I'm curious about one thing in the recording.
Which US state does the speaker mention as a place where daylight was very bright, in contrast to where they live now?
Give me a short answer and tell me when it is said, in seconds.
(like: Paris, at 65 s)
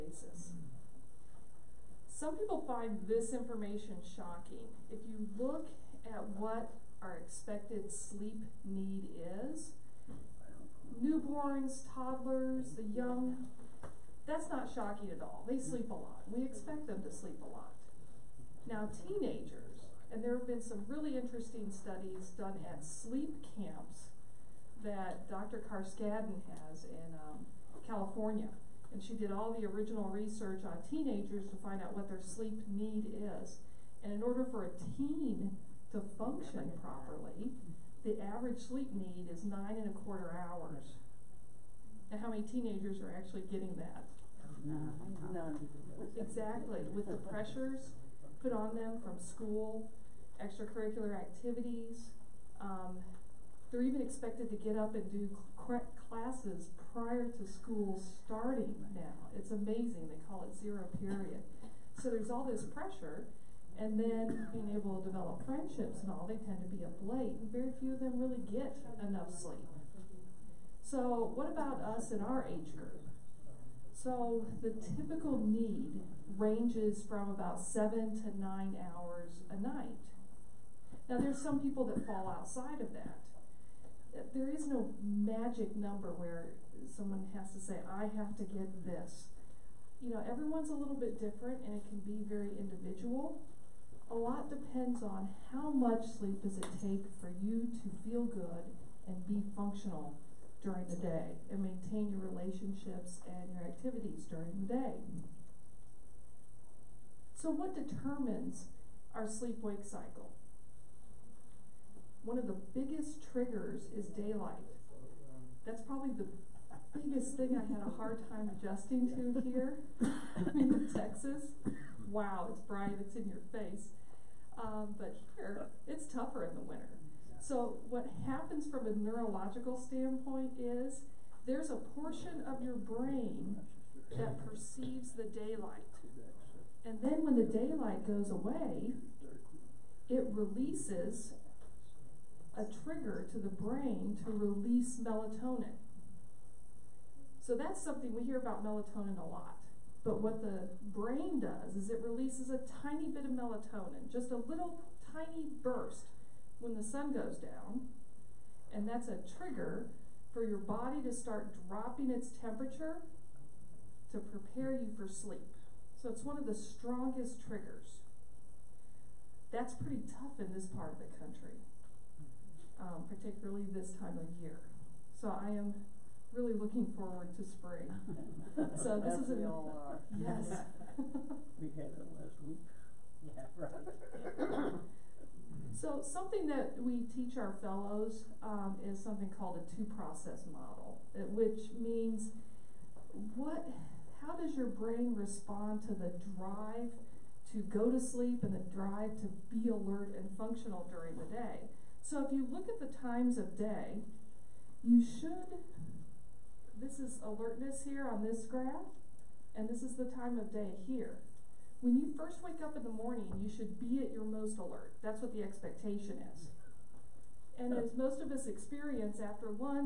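Texas, at 120 s.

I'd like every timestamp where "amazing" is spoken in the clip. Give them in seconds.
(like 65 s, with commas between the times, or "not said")
59 s.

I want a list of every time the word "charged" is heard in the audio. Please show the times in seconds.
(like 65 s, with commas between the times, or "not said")
not said.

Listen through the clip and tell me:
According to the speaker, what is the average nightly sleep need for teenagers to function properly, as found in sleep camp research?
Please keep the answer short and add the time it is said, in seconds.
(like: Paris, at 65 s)
9 and a quarter hours, at 39 s.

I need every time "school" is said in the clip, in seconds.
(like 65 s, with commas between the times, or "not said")
49 s, 57 s.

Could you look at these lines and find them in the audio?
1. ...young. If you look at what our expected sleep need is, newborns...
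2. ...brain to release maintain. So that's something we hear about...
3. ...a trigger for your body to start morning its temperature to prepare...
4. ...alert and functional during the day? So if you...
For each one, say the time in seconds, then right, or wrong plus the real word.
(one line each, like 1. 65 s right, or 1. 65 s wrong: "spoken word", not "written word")
1. 4 s wrong: "shocking", not "young"
2. 143 s wrong: "melatonin", not "maintain"
3. 159 s wrong: "dropping", not "morning"
4. 199 s right.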